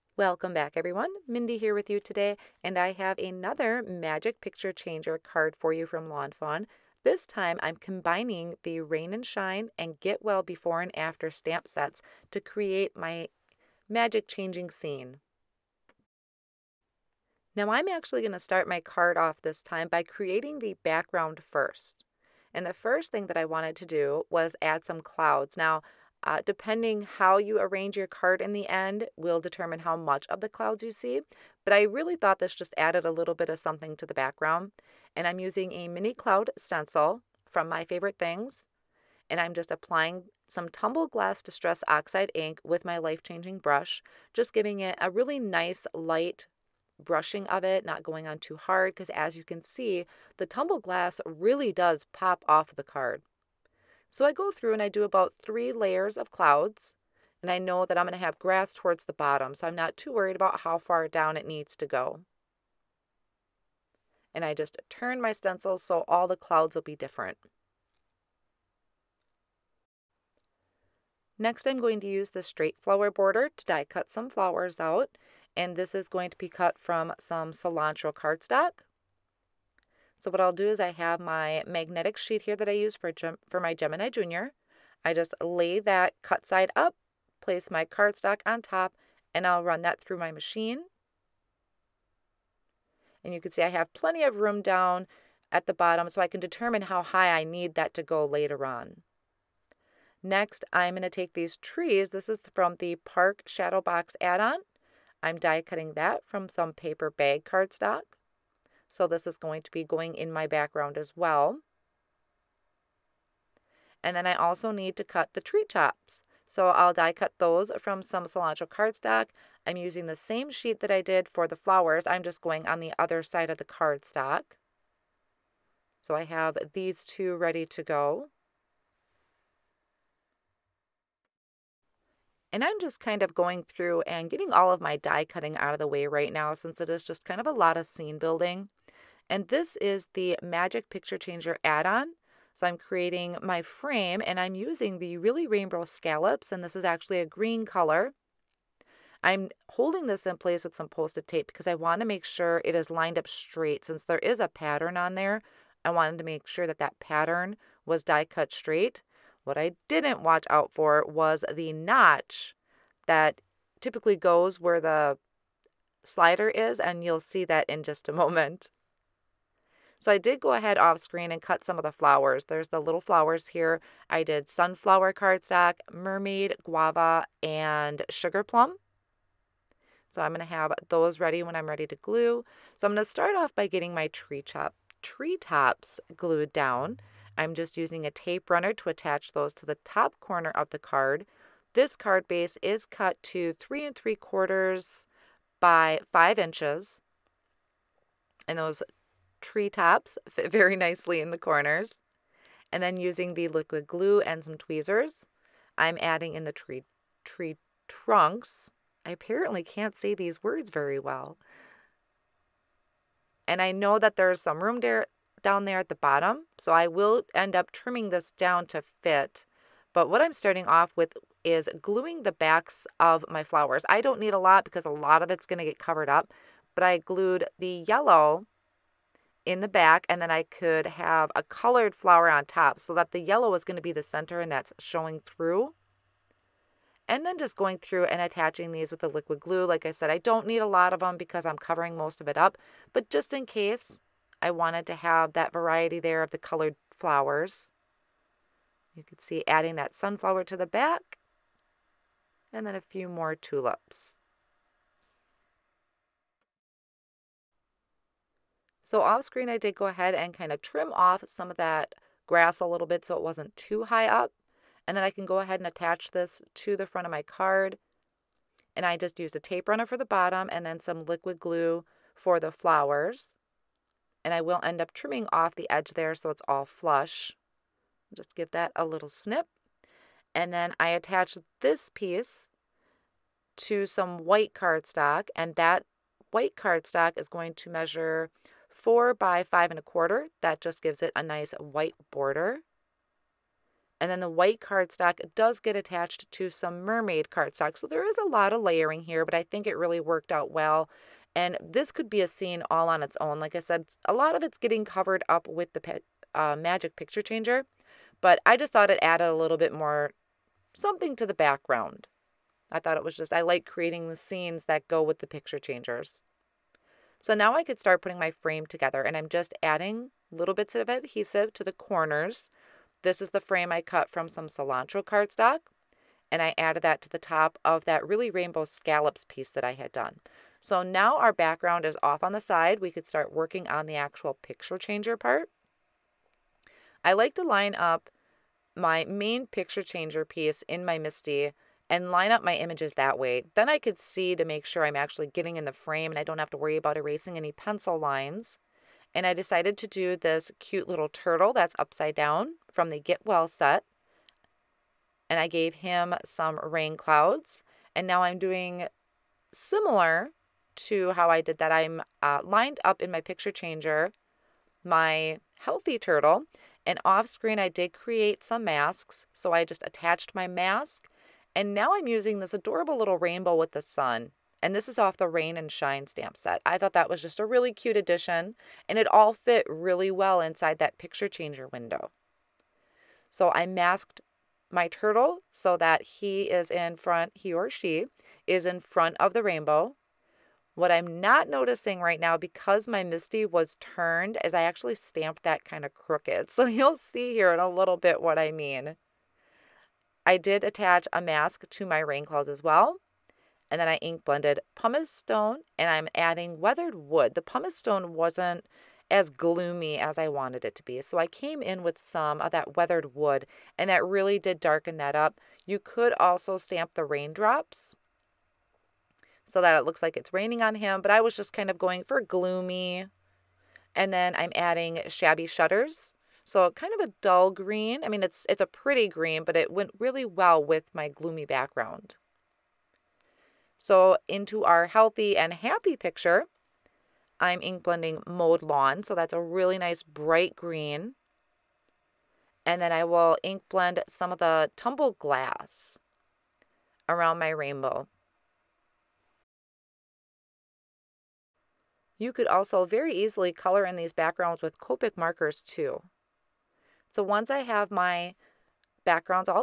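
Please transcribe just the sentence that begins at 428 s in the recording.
I mean, it's it's a pretty green, but it went really well with my gloomy background.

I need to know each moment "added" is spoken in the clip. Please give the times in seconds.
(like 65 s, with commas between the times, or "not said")
32 s, 309 s, 326 s.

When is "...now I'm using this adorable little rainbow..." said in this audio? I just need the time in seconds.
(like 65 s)
371 s.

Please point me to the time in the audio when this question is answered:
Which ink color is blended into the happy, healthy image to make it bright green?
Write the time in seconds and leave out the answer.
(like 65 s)
438 s.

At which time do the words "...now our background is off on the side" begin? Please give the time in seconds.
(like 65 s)
330 s.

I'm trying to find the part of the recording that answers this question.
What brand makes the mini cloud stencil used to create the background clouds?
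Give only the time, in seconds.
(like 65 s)
37 s.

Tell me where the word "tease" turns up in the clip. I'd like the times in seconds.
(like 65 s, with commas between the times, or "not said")
not said.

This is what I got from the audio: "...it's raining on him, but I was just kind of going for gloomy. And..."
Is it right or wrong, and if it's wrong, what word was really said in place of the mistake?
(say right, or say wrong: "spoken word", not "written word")
right.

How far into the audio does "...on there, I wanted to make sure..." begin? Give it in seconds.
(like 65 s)
154 s.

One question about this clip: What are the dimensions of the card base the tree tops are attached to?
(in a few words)
3 3/4 by 5 inches.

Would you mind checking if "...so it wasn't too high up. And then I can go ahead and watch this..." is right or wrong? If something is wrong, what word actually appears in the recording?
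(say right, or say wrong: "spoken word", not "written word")
wrong: "attach", not "watch".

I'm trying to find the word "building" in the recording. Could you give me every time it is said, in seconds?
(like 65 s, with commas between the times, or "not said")
138 s.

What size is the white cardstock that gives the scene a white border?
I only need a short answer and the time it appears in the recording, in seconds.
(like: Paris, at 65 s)
4 by 5 1/4, at 288 s.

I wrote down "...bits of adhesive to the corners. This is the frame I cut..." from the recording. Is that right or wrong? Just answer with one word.
right.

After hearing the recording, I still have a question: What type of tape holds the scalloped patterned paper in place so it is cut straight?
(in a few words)
Post-it tape.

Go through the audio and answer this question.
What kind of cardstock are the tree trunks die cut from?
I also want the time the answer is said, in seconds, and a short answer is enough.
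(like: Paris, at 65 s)
Paper bag, at 106 s.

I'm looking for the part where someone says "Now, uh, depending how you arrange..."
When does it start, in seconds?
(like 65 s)
25 s.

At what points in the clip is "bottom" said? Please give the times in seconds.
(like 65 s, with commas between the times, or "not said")
59 s, 95 s, 215 s, 270 s.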